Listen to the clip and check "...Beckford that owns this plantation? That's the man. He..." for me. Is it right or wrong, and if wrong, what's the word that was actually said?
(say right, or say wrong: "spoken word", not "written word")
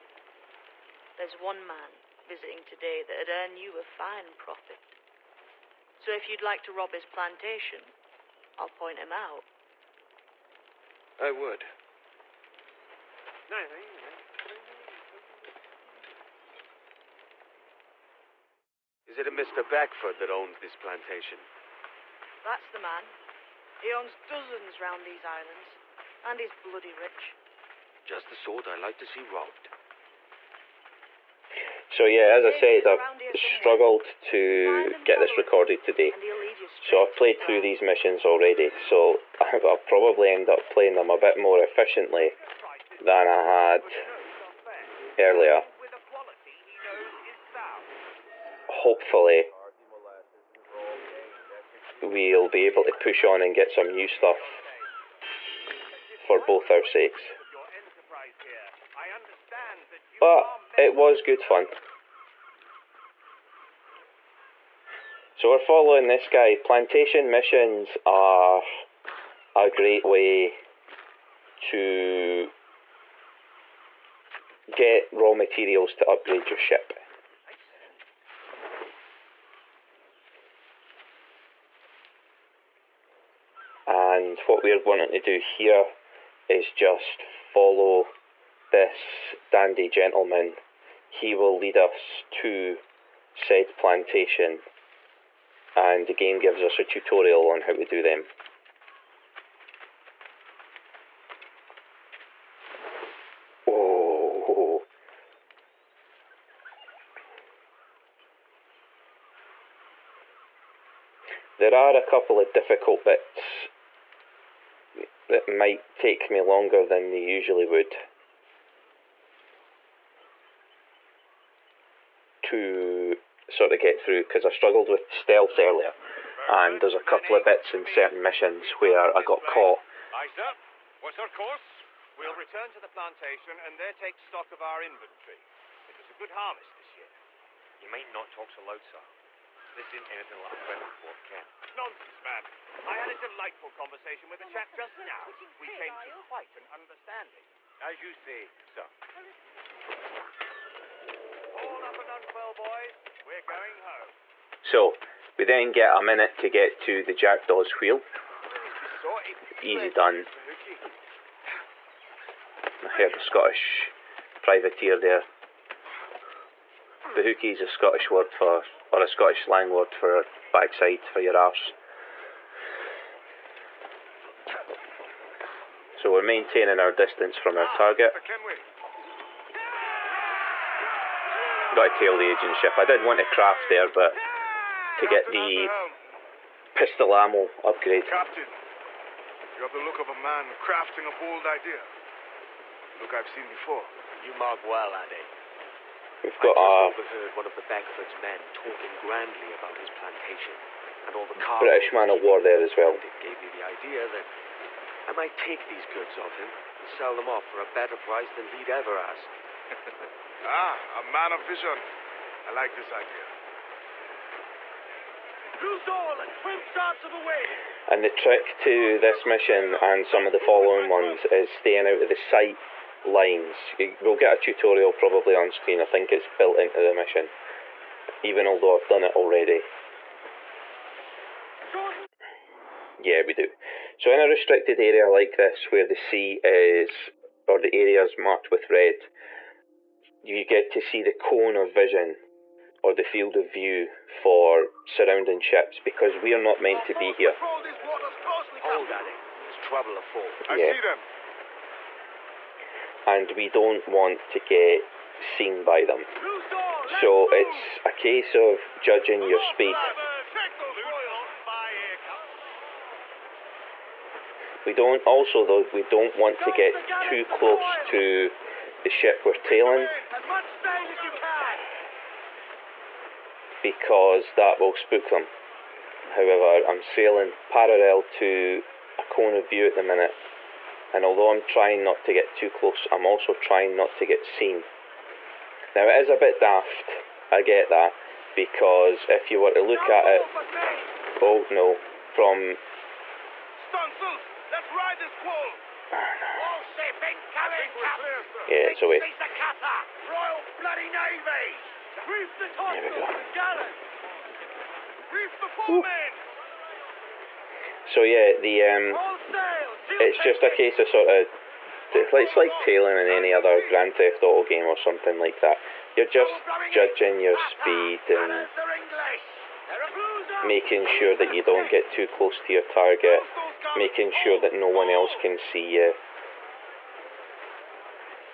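right.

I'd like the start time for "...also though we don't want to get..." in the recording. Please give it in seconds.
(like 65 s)
265 s.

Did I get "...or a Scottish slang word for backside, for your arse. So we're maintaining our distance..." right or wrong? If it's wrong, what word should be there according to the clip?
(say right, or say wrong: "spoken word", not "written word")
right.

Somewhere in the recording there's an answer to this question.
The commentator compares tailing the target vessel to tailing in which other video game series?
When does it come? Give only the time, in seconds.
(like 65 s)
313 s.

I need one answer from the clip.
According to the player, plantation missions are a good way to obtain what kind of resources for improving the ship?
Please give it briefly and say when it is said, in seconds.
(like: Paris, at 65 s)
raw materials, at 75 s.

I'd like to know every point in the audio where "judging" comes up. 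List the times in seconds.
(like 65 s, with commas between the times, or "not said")
258 s, 316 s.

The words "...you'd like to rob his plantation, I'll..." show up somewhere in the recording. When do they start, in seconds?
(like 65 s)
6 s.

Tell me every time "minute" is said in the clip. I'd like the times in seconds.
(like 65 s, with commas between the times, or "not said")
156 s, 279 s.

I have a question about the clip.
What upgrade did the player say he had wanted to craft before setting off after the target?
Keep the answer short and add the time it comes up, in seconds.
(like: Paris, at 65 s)
pistol ammo upgrade, at 186 s.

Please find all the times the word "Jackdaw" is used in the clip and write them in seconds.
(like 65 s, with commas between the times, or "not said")
157 s.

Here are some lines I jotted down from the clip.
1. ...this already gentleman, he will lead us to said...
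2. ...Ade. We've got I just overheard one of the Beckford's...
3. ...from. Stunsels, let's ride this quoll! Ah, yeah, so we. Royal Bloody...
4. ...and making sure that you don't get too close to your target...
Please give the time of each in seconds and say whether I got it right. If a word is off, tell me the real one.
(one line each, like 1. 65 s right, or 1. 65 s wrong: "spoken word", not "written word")
1. 88 s wrong: "dandy", not "already"
2. 194 s right
3. 292 s right
4. 318 s right.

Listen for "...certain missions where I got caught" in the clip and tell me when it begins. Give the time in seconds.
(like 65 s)
127 s.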